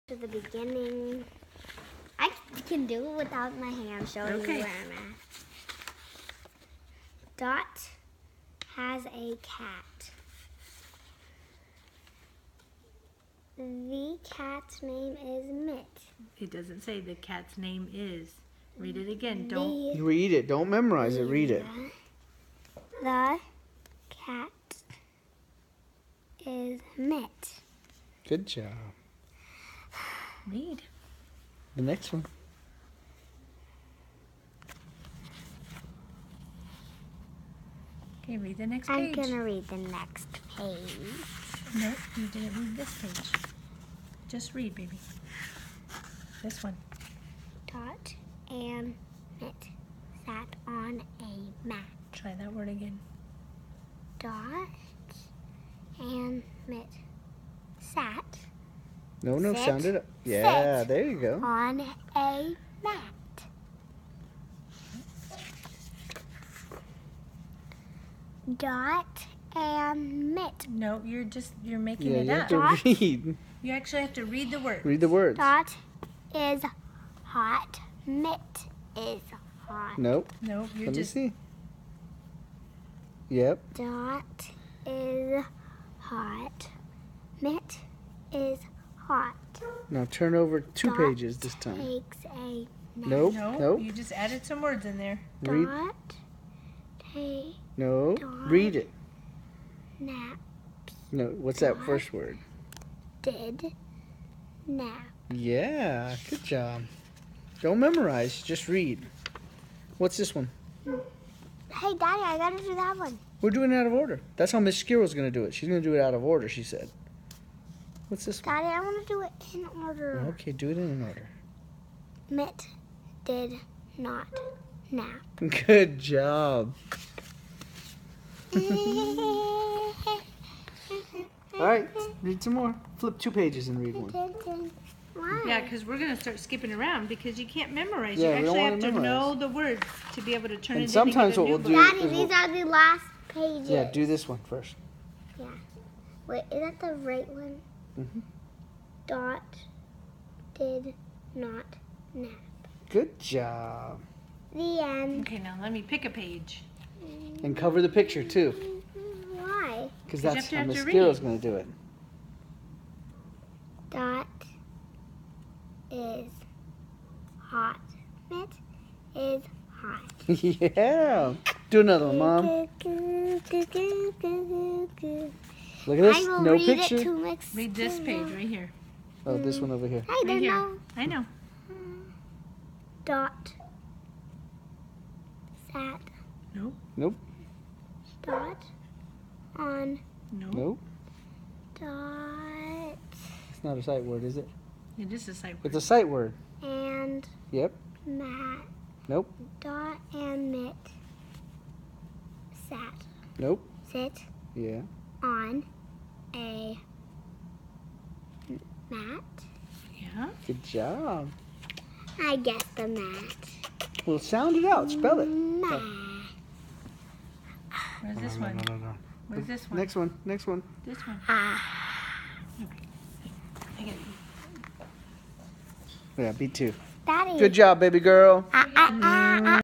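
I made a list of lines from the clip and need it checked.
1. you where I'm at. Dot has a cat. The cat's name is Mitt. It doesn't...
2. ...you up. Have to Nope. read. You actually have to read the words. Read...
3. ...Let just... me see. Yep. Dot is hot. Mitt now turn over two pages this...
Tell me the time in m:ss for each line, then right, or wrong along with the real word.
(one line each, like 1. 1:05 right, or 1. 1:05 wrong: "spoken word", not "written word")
1. 0:04 right
2. 1:12 wrong: "Dot", not "Nope"
3. 1:20 right.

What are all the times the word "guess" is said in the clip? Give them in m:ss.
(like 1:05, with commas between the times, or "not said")
3:32.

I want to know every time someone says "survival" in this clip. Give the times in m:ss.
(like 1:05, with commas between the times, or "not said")
not said.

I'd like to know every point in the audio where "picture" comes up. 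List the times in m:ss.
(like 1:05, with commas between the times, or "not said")
2:37, 2:56.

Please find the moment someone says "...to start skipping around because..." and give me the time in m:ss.
2:16.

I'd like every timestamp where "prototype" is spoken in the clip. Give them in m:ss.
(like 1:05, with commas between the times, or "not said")
not said.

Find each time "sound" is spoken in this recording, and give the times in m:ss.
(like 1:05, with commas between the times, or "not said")
0:59, 3:34.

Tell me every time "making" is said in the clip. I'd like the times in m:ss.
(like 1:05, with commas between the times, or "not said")
1:11.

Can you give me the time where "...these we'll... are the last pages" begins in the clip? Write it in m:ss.
2:22.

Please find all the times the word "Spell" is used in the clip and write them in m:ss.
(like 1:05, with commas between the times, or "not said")
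3:34.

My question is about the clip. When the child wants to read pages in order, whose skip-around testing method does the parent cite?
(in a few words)
Miss Skiro.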